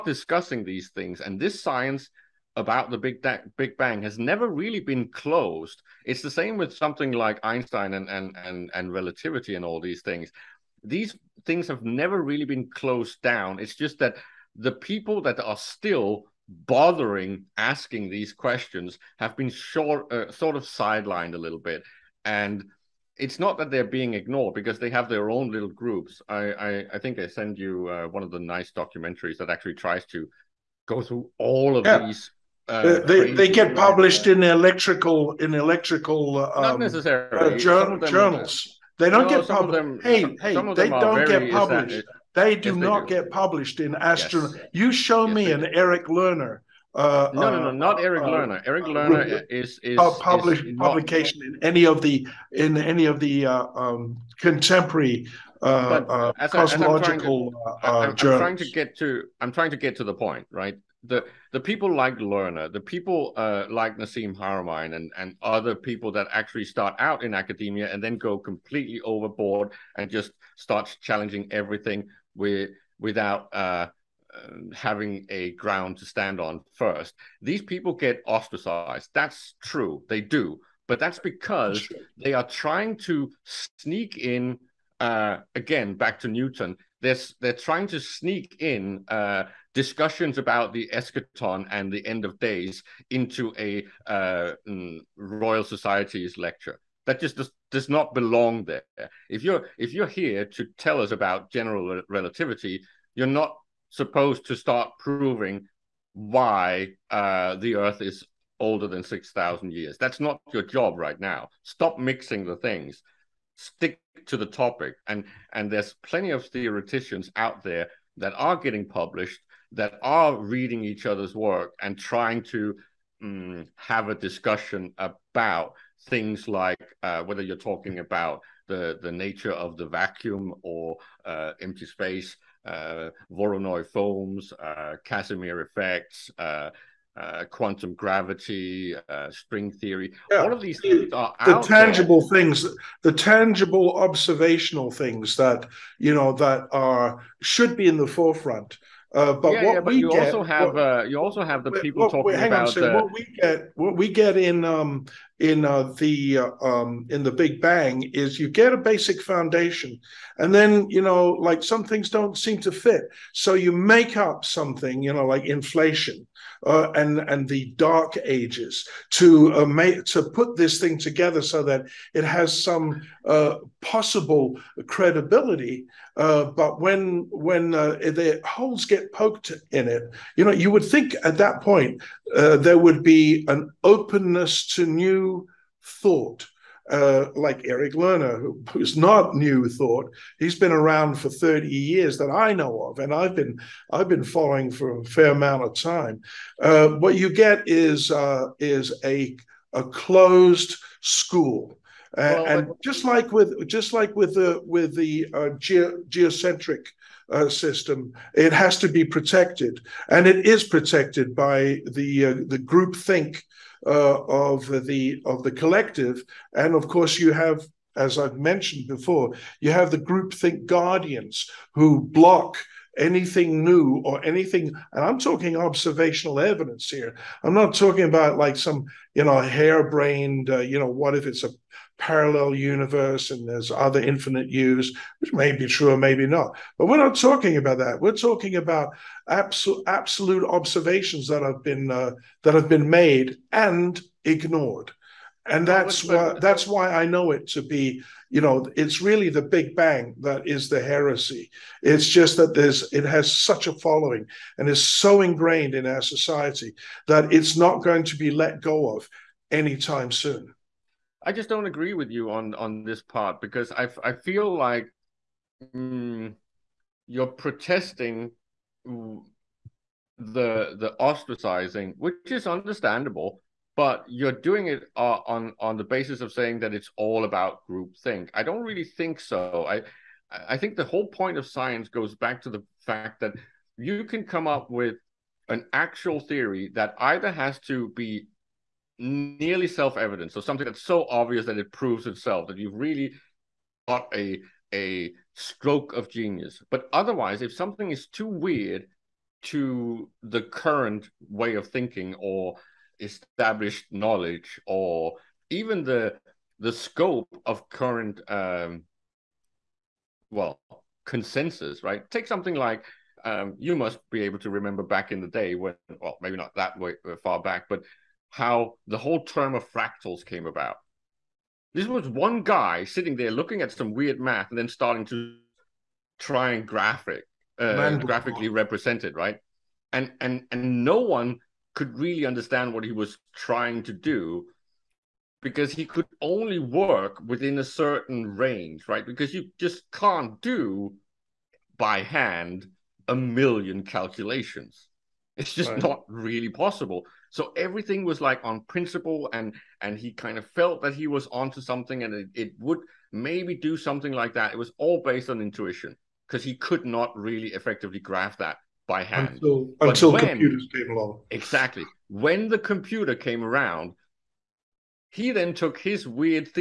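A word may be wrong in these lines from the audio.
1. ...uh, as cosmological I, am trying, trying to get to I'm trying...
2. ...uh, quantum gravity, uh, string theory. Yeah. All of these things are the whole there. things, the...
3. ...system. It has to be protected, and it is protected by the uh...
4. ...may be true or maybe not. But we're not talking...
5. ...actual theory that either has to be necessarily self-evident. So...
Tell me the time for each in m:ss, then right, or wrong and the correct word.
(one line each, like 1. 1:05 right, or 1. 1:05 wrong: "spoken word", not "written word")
1. 0:55 right
2. 2:17 wrong: "tangible", not "whole"
3. 3:27 right
4. 3:55 right
5. 4:45 wrong: "nearly", not "necessarily".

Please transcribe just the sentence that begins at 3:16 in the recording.
Uh, what you get is uh, is a a closed school.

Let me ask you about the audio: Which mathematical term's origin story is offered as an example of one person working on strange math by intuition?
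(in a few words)
fractals.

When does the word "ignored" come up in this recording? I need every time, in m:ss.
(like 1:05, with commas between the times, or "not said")
0:24, 4:04.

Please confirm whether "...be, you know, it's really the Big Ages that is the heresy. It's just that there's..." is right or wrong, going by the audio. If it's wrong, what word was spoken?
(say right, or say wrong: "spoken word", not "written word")
wrong: "Bang", not "Ages".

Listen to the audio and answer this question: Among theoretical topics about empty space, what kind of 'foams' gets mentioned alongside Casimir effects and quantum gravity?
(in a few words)
Voronoi foams.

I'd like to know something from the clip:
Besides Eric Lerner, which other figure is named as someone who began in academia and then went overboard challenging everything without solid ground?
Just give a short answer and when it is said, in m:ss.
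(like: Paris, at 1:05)
Nassim Haramein, at 1:03.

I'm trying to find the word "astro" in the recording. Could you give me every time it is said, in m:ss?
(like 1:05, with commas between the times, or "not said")
0:43.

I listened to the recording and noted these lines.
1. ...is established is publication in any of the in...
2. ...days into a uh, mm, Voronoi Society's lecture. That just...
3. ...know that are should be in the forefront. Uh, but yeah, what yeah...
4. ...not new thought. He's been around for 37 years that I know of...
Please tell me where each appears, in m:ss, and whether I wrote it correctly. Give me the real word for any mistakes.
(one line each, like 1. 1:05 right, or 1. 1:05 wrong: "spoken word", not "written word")
1. 0:49 wrong: "published", not "established"
2. 1:32 wrong: "Royal", not "Voronoi"
3. 2:26 right
4. 3:08 wrong: "30", not "37".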